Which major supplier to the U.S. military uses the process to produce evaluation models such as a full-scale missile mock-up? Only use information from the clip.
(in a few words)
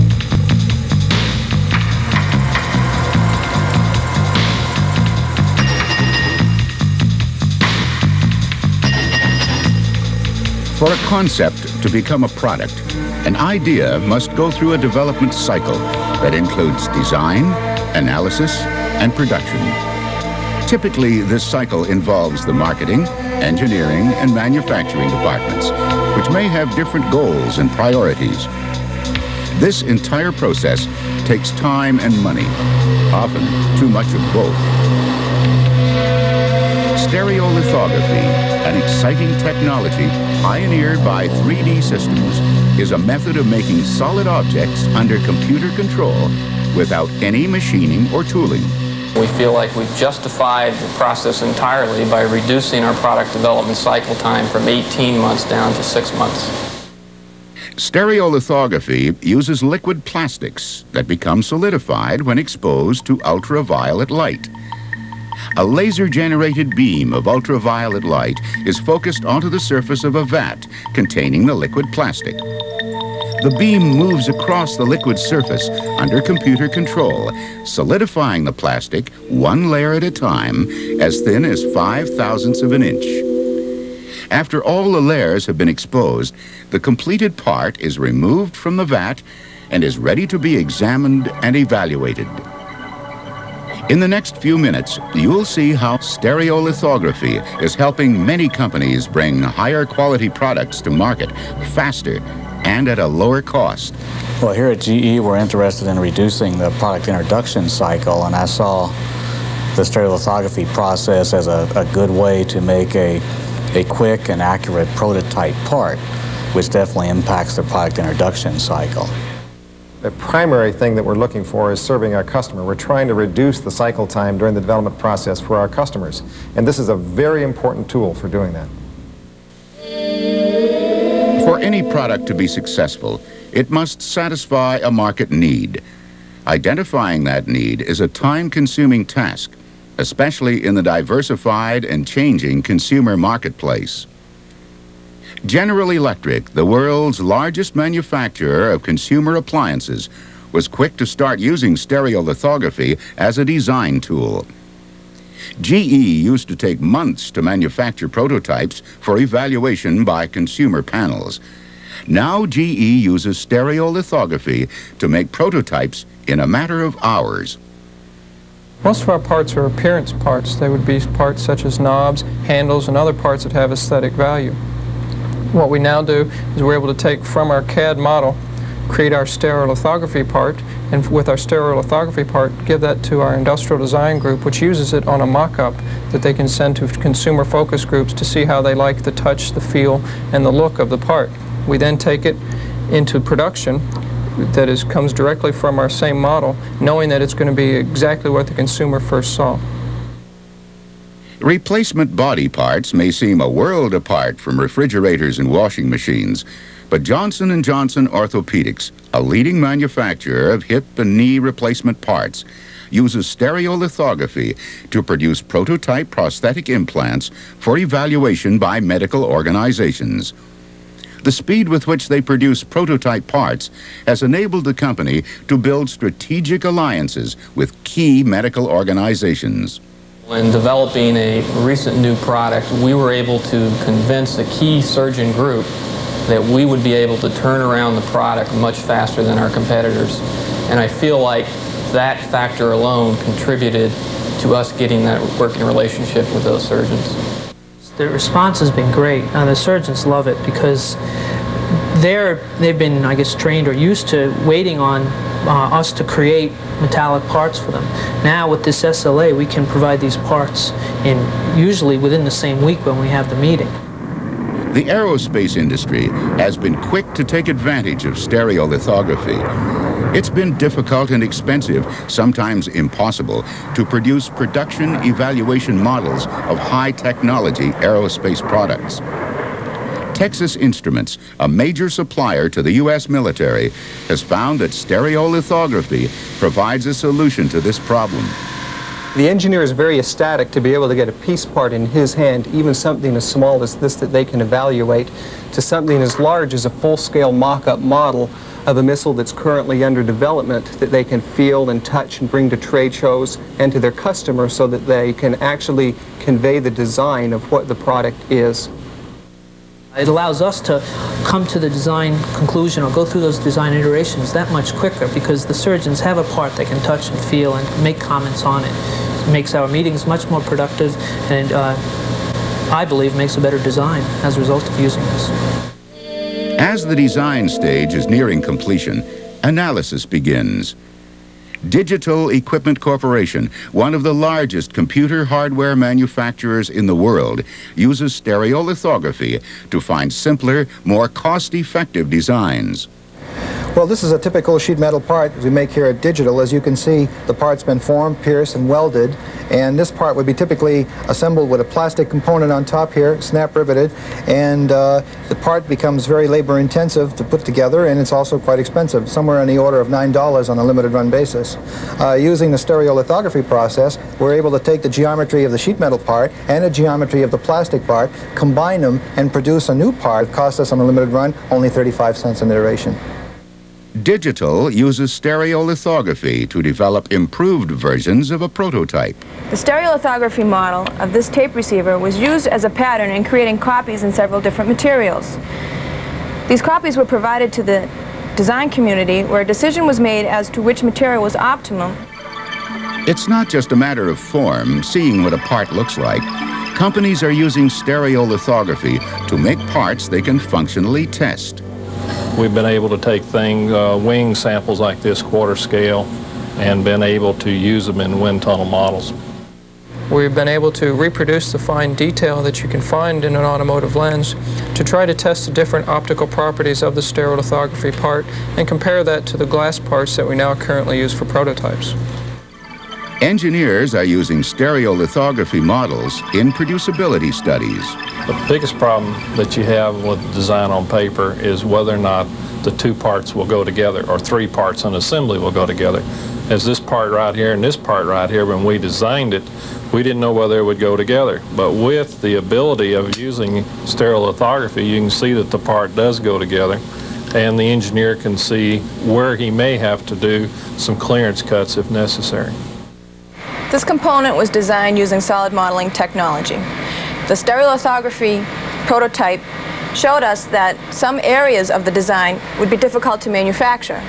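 Texas Instruments.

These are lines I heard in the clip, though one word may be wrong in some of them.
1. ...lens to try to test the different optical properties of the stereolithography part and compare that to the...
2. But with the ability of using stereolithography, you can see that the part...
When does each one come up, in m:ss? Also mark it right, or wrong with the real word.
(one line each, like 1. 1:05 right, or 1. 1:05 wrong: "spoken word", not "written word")
1. 6:53 right
2. 7:21 right.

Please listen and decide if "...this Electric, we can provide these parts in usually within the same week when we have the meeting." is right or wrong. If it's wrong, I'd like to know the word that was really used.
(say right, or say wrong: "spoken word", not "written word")
wrong: "SLA", not "Electric".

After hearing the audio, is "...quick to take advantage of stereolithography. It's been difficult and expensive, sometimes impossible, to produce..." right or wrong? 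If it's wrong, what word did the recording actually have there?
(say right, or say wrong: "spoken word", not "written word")
right.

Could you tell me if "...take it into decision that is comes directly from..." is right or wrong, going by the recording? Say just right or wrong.
wrong.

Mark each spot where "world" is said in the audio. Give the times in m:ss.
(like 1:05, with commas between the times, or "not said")
2:26, 3:23, 5:36.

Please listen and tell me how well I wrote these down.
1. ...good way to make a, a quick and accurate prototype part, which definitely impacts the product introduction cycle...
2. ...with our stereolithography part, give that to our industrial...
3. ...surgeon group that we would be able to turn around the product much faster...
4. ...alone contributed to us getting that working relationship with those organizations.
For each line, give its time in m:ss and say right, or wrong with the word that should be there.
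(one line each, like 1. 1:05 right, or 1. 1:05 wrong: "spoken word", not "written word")
1. 1:51 right
2. 3:01 right
3. 3:54 right
4. 4:02 wrong: "surgeons", not "organizations".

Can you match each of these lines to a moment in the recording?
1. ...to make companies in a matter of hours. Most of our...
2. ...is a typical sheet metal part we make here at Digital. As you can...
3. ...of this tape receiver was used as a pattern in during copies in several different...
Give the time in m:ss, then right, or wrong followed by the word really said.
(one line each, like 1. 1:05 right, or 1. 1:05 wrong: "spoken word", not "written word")
1. 2:44 wrong: "prototypes", not "companies"
2. 5:44 right
3. 6:21 wrong: "creating", not "during".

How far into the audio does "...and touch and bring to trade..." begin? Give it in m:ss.
5:01.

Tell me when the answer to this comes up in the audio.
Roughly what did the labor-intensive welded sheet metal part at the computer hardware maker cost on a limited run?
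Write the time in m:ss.
5:59.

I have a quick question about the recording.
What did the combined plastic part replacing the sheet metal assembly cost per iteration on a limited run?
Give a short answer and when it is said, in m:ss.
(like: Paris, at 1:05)
35 cents, at 6:11.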